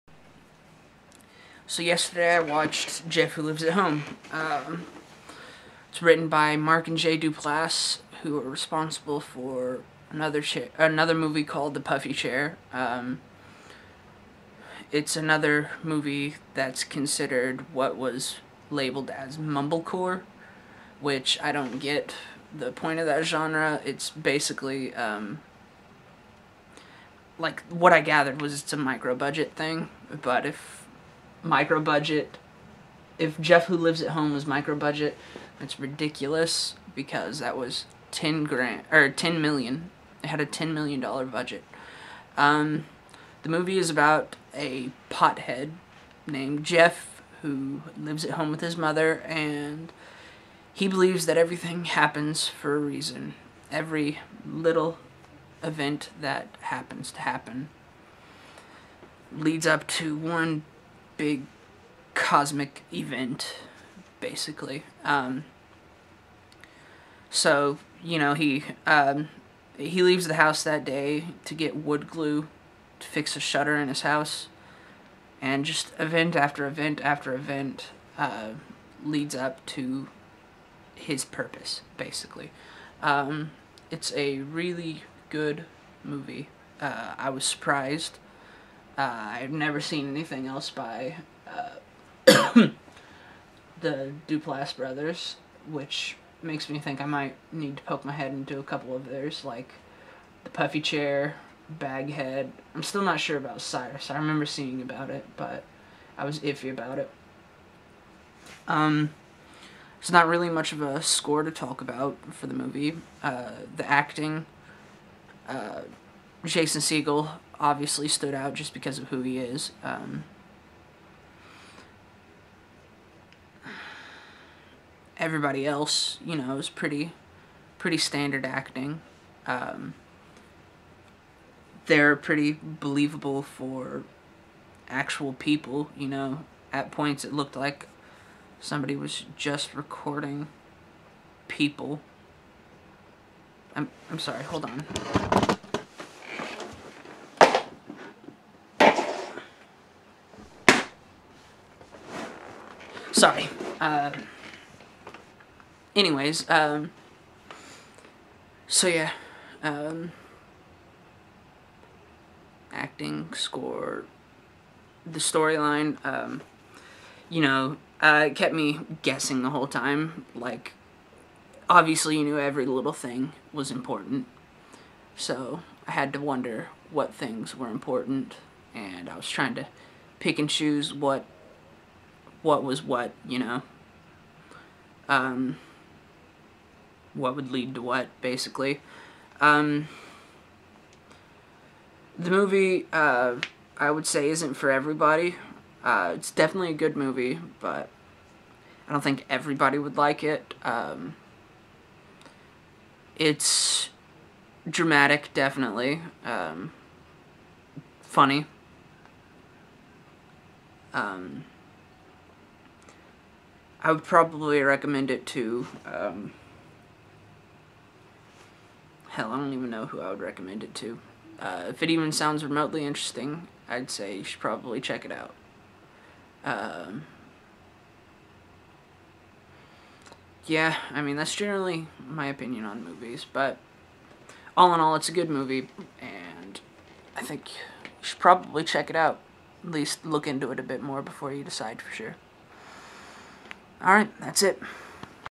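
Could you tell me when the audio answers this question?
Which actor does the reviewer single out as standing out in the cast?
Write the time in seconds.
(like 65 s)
116 s.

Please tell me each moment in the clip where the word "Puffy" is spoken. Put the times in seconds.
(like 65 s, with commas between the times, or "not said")
11 s, 100 s.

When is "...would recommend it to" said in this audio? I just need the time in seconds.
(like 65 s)
220 s.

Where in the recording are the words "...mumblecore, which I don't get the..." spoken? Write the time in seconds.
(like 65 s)
19 s.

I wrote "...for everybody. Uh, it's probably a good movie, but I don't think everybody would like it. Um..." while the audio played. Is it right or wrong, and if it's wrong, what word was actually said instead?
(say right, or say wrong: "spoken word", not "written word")
wrong: "definitely", not "probably".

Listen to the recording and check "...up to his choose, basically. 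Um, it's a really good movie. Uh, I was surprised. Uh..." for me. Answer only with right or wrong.
wrong.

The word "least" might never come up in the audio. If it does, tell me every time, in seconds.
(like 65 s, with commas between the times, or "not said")
239 s.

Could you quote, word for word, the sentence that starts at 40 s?
It had a 10 million dollar budget.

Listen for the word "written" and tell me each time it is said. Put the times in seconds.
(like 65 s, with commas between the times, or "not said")
6 s.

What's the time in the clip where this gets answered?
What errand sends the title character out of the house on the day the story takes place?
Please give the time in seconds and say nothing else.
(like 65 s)
71 s.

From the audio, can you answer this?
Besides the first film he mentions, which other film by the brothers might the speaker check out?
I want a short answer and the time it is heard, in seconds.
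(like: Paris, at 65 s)
Baghead, at 101 s.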